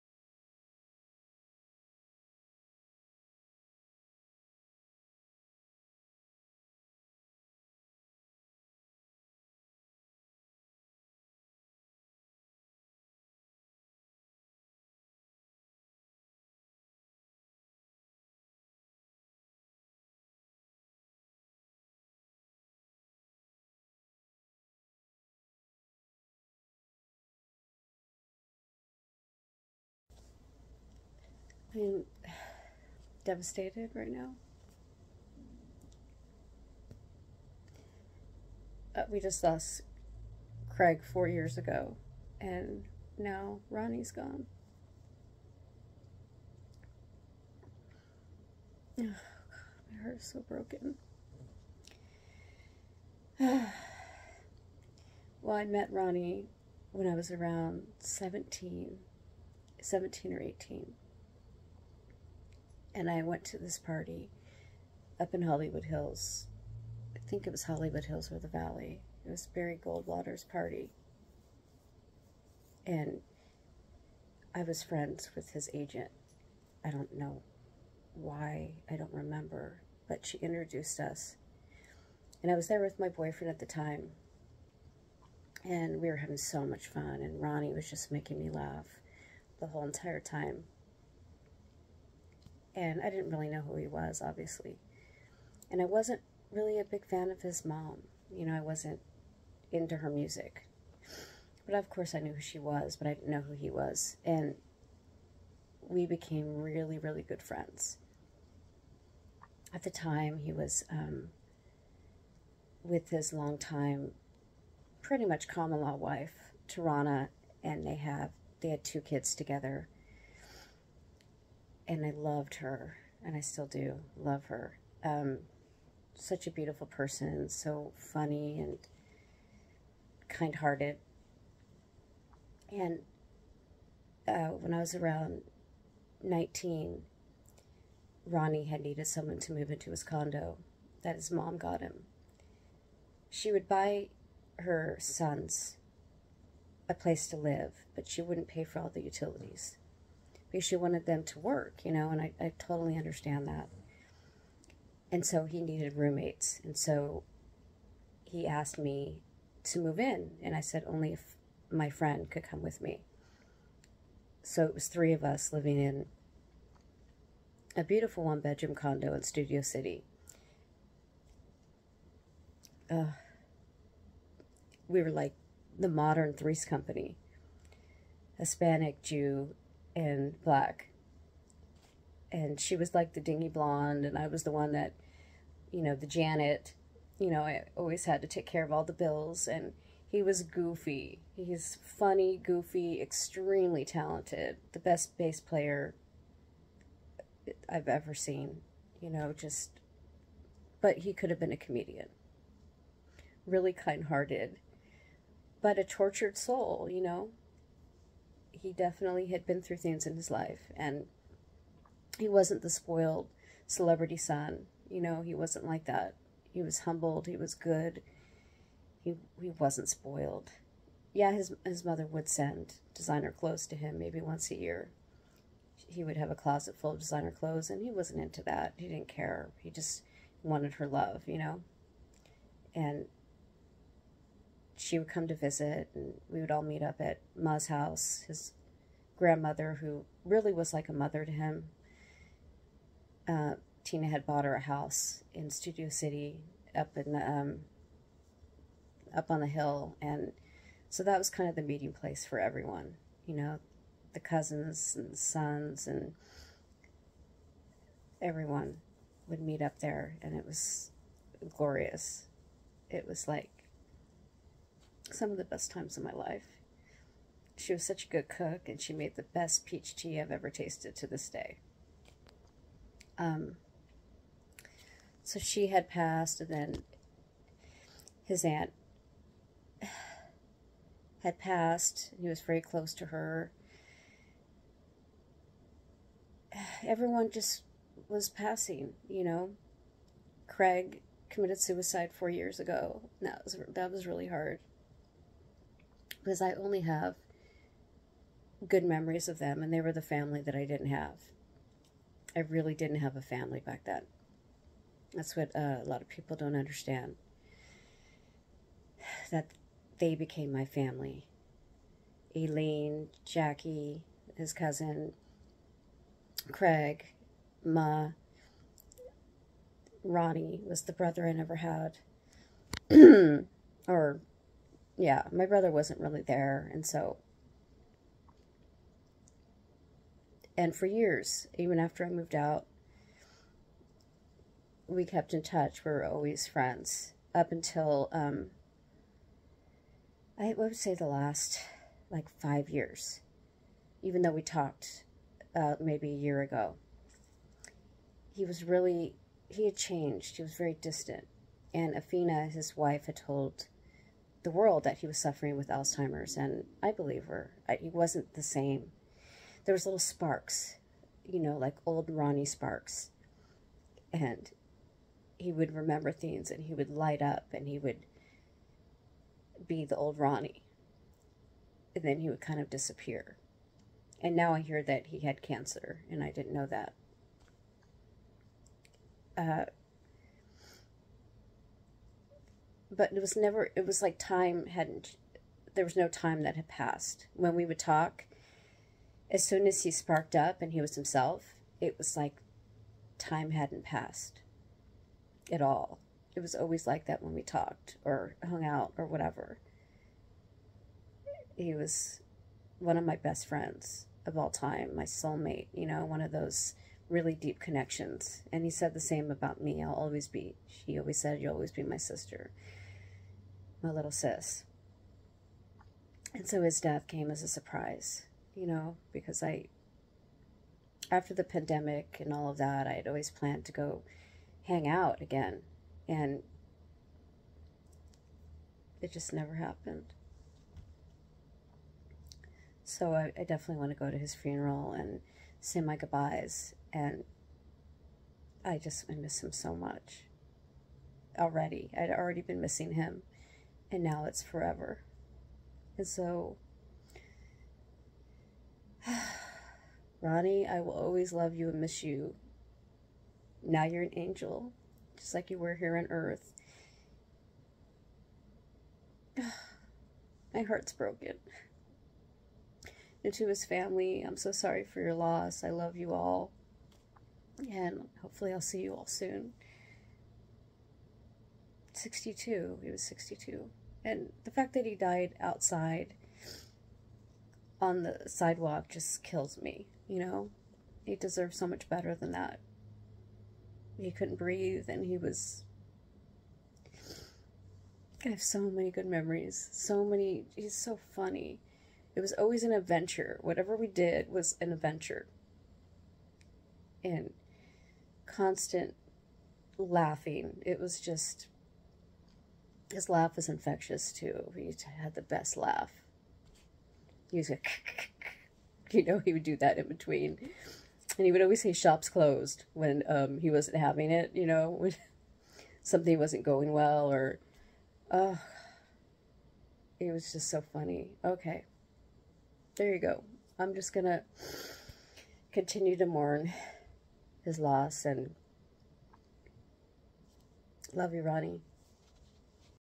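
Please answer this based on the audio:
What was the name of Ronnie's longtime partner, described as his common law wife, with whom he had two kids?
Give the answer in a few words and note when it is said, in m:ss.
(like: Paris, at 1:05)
Tarana, at 1:56.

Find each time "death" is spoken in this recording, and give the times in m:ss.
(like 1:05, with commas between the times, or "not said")
6:56.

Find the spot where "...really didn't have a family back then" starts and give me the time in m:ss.
5:02.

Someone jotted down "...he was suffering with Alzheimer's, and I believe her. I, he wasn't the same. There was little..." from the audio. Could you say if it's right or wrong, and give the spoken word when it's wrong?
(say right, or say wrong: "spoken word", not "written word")
right.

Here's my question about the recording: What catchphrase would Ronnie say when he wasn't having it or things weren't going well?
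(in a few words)
Shops closed.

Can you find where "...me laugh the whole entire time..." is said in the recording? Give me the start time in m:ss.
1:28.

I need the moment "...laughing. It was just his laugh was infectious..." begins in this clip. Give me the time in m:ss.
8:19.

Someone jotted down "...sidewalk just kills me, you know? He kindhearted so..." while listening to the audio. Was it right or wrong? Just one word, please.
wrong.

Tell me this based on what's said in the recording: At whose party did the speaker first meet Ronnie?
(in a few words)
Barry Goldwater.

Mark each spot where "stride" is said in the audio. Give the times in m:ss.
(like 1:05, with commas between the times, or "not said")
not said.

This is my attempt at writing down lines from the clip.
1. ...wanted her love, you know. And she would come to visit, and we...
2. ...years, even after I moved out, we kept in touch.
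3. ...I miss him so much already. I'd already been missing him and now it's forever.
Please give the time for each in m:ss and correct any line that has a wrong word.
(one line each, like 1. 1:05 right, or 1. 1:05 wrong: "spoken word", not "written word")
1. 3:50 right
2. 5:30 right
3. 7:19 right.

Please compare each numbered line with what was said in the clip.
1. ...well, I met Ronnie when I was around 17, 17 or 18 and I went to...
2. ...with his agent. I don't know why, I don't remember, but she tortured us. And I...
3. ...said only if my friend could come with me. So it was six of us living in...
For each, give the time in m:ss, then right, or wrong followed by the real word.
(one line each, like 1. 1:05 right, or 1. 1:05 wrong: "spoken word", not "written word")
1. 0:55 right
2. 1:15 wrong: "introduced", not "tortured"
3. 2:40 wrong: "three", not "six".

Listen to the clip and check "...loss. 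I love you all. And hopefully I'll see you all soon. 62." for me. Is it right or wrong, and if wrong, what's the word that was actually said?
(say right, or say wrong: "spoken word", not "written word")
right.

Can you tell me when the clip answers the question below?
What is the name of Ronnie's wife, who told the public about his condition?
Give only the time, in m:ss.
5:51.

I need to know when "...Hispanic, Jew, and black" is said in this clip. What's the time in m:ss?
2:58.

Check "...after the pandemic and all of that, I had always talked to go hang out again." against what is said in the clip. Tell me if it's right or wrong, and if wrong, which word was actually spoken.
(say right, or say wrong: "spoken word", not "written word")
wrong: "planned", not "talked".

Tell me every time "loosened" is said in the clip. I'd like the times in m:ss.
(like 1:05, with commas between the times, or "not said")
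not said.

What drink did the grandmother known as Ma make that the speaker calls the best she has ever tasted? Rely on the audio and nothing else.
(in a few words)
Peach tea.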